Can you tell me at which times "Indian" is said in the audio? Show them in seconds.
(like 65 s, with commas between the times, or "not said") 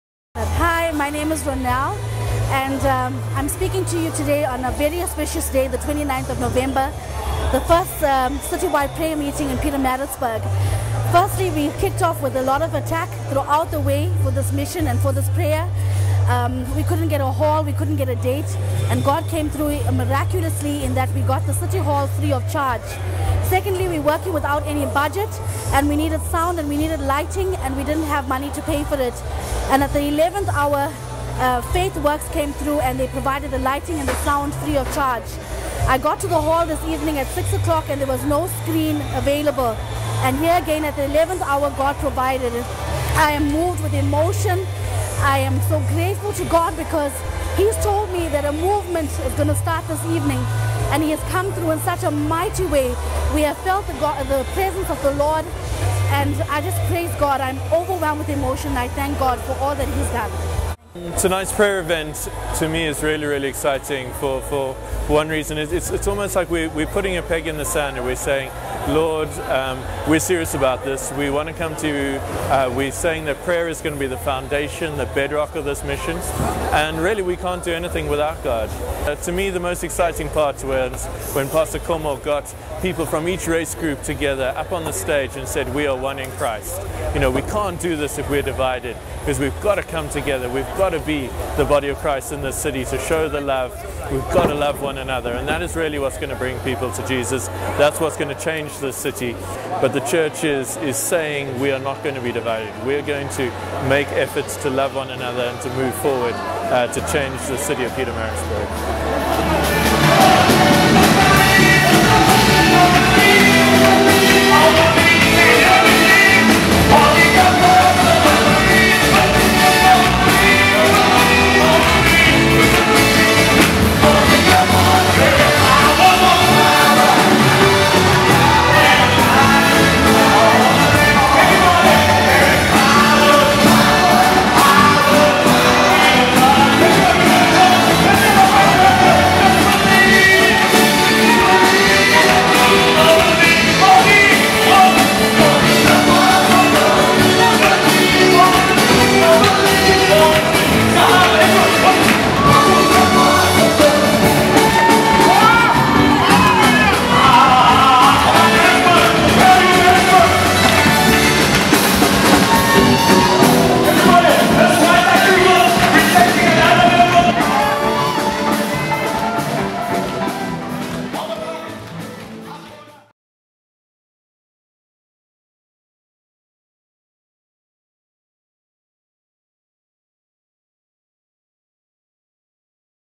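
not said.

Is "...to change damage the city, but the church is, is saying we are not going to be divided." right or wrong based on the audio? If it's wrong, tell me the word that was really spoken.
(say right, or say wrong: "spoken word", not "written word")
right.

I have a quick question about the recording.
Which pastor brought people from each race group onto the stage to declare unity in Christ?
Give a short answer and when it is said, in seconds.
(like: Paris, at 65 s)
Pastor Como, at 81 s.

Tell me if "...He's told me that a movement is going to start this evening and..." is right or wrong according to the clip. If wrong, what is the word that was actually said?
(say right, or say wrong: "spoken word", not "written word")
right.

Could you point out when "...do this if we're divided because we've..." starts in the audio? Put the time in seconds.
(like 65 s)
87 s.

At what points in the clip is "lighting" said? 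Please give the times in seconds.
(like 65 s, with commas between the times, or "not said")
27 s, 33 s.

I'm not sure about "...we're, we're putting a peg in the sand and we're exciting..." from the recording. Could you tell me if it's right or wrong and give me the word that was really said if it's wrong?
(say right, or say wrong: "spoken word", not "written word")
wrong: "saying", not "exciting".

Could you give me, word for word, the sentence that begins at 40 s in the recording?
And here again at the 11th hour, God provided.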